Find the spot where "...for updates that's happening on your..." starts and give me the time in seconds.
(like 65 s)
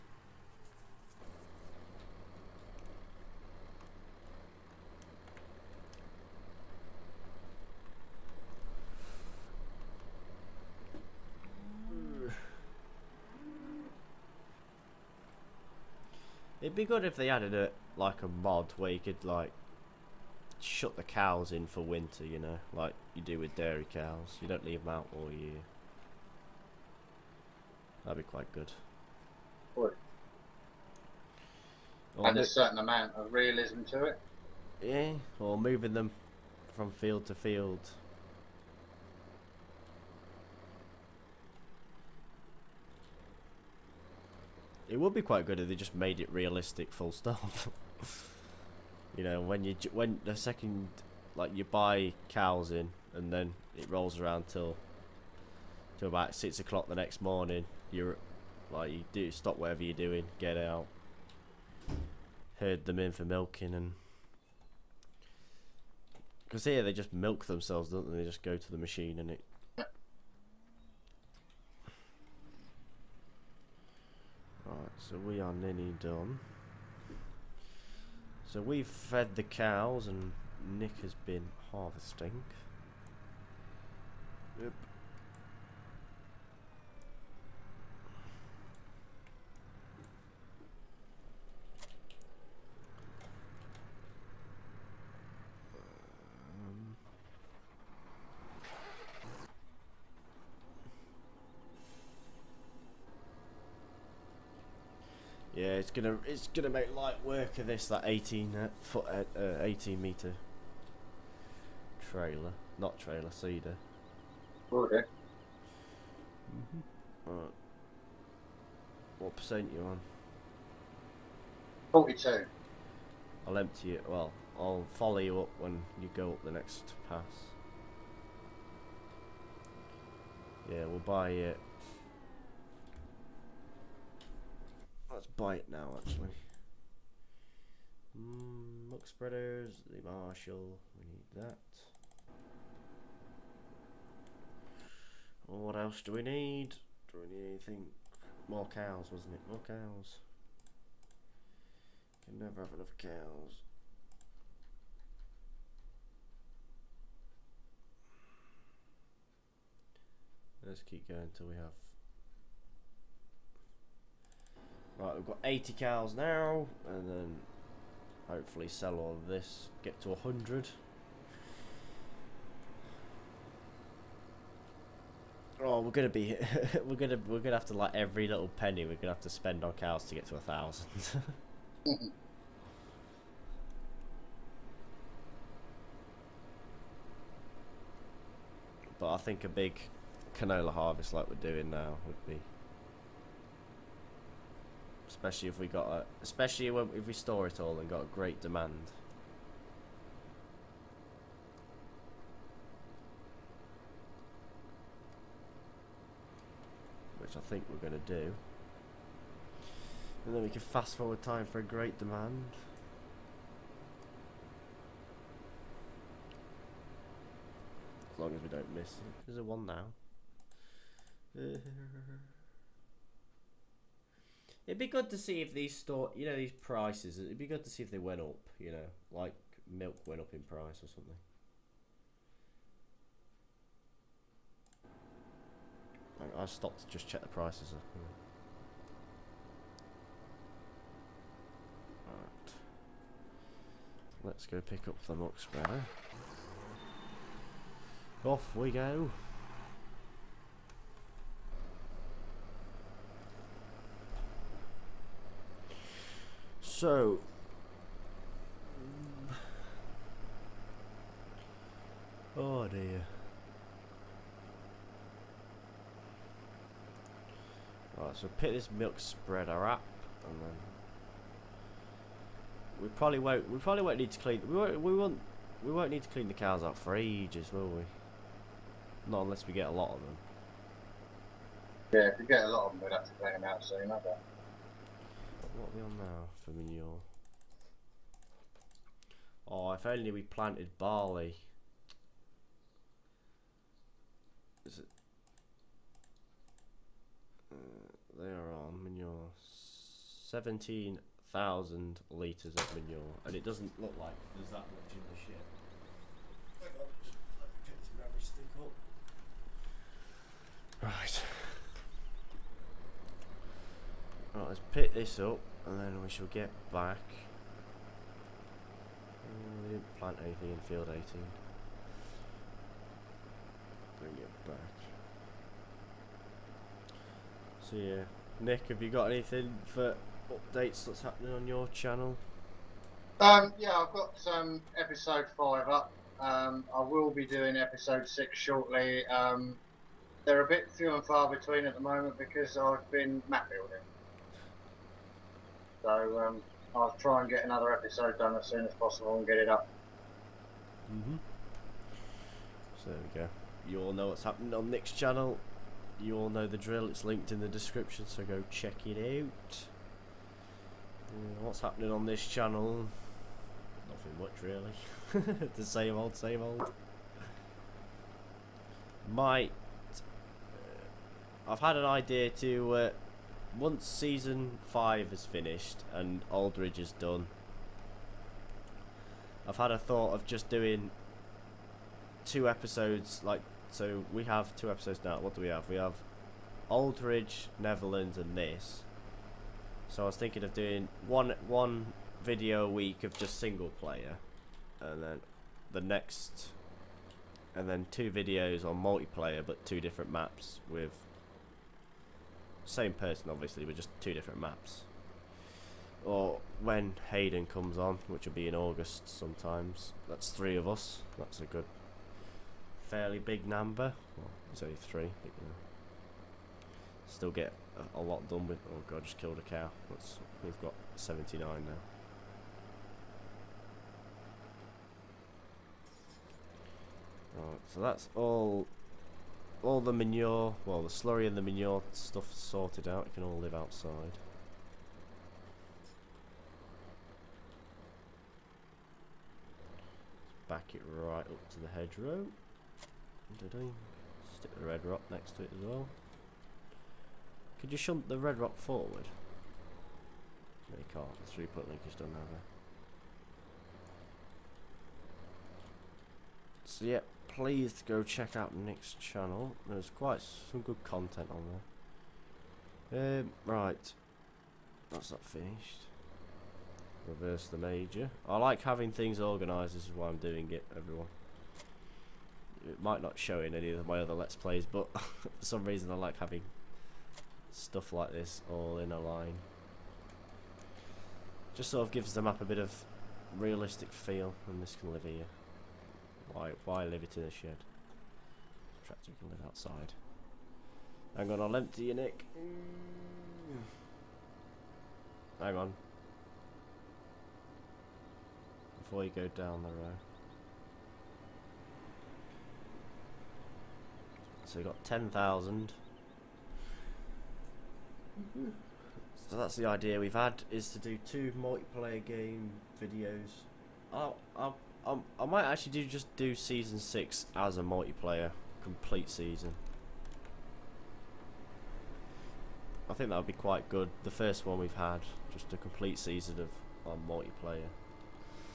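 329 s.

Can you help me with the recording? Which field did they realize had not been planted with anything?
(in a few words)
Field 18.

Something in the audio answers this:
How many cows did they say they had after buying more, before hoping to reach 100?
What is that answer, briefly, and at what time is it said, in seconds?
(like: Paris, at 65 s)
80, at 165 s.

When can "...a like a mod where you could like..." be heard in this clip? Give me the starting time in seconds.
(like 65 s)
17 s.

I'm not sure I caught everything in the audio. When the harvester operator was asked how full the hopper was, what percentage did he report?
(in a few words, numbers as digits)
42.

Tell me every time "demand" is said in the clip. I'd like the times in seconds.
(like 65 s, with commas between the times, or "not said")
198 s, 211 s.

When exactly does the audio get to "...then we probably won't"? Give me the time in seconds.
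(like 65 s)
270 s.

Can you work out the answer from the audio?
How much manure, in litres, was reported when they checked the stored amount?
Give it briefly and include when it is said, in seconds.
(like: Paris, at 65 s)
17,000 litres, at 300 s.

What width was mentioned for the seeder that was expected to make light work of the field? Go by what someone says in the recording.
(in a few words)
18 meters.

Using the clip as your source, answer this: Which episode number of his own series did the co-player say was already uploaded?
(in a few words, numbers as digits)
Episode 5.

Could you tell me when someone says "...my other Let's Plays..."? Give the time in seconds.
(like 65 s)
473 s.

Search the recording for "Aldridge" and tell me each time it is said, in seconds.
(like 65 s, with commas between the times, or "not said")
376 s, 386 s.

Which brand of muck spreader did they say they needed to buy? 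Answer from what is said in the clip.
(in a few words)
Marshall.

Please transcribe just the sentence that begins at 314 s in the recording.
Right, let's pick this up and then we shall get back.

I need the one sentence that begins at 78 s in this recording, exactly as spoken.
So we've fed the cows and Nick has been harvesting.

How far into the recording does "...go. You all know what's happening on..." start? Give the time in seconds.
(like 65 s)
353 s.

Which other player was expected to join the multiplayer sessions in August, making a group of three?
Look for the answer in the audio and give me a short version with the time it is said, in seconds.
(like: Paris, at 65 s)
Hayden, at 407 s.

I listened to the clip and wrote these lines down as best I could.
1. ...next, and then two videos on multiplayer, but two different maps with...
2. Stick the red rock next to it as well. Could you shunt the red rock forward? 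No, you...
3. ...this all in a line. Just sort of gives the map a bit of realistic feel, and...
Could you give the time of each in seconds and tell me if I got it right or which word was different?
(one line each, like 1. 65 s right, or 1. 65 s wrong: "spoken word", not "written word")
1. 395 s right
2. 444 s right
3. 478 s right.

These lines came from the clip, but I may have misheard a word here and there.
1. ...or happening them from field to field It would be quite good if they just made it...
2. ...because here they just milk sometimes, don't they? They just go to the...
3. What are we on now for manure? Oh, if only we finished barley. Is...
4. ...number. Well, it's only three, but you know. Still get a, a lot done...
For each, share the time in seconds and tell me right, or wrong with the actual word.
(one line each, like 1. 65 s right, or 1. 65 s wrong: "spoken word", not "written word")
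1. 35 s wrong: "moving", not "happening"
2. 66 s wrong: "themselves", not "sometimes"
3. 285 s wrong: "planted", not "finished"
4. 413 s right.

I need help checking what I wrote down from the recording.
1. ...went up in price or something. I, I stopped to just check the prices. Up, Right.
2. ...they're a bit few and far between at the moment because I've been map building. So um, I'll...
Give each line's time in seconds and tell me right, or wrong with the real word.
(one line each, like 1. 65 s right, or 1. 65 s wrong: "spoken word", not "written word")
1. 230 s right
2. 340 s right.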